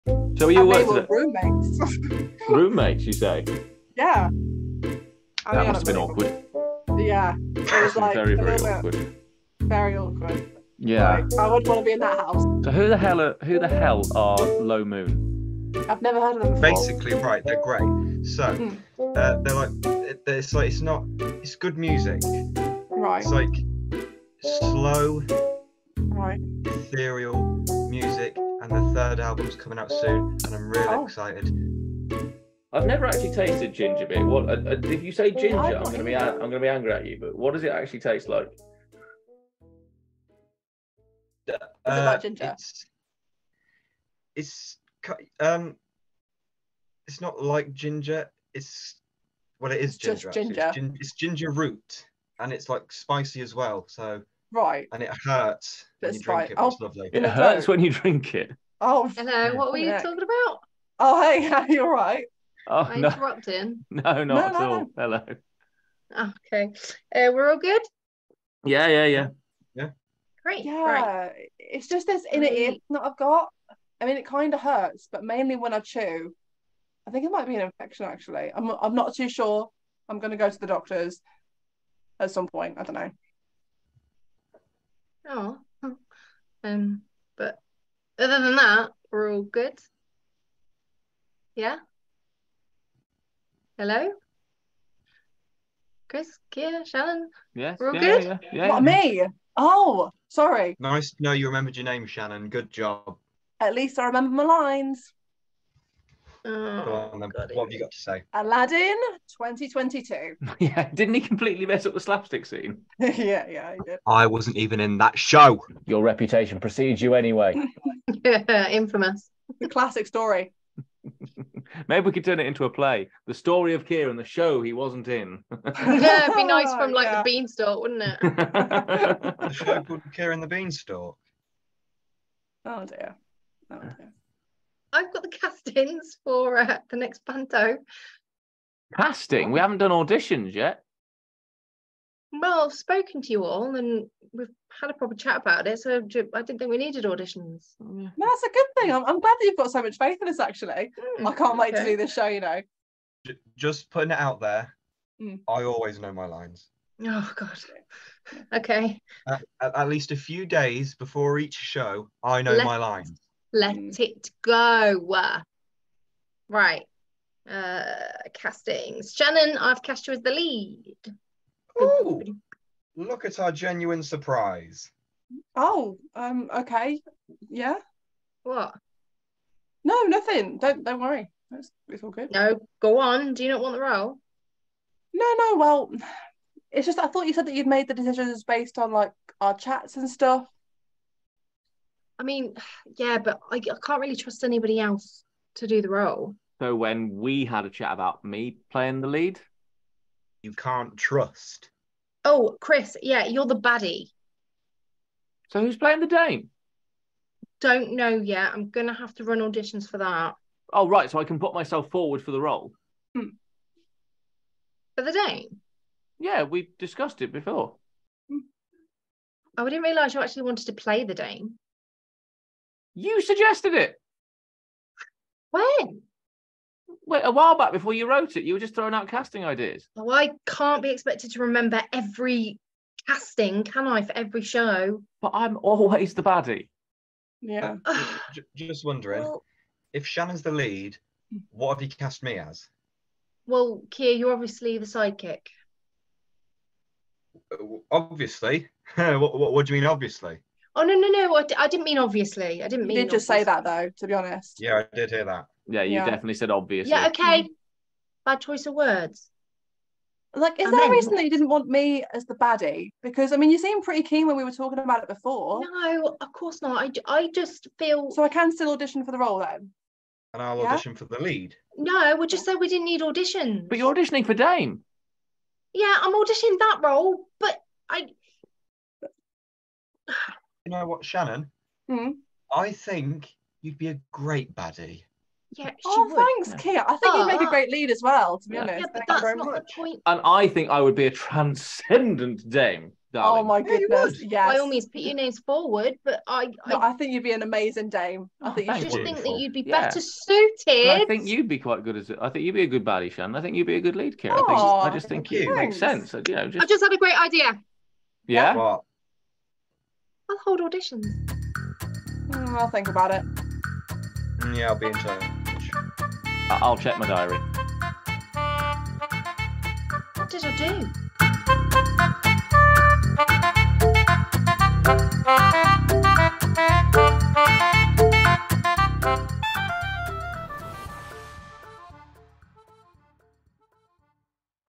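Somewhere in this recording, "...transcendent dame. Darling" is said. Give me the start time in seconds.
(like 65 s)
291 s.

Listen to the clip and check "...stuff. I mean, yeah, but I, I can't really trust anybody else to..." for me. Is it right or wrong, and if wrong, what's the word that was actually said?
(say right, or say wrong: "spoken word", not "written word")
right.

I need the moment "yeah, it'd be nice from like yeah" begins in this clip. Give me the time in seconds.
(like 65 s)
125 s.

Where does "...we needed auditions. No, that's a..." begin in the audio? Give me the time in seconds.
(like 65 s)
146 s.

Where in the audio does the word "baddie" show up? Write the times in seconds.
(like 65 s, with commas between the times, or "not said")
203 s, 236 s, 262 s, 284 s, 302 s.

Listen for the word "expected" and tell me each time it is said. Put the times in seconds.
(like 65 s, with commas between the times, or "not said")
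230 s.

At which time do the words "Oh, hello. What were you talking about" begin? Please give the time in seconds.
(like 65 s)
58 s.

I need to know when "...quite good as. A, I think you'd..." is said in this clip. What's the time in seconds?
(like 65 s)
301 s.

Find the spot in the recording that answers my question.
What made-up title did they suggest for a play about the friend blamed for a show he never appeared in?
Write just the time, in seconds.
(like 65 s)
130 s.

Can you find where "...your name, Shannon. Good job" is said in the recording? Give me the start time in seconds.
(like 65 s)
101 s.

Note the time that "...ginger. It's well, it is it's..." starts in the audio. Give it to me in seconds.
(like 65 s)
47 s.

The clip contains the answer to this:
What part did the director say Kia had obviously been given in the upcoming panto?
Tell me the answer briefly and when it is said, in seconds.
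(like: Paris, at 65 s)
the sidekick, at 244 s.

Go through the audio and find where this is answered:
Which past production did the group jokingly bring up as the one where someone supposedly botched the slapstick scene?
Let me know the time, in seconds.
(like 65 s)
108 s.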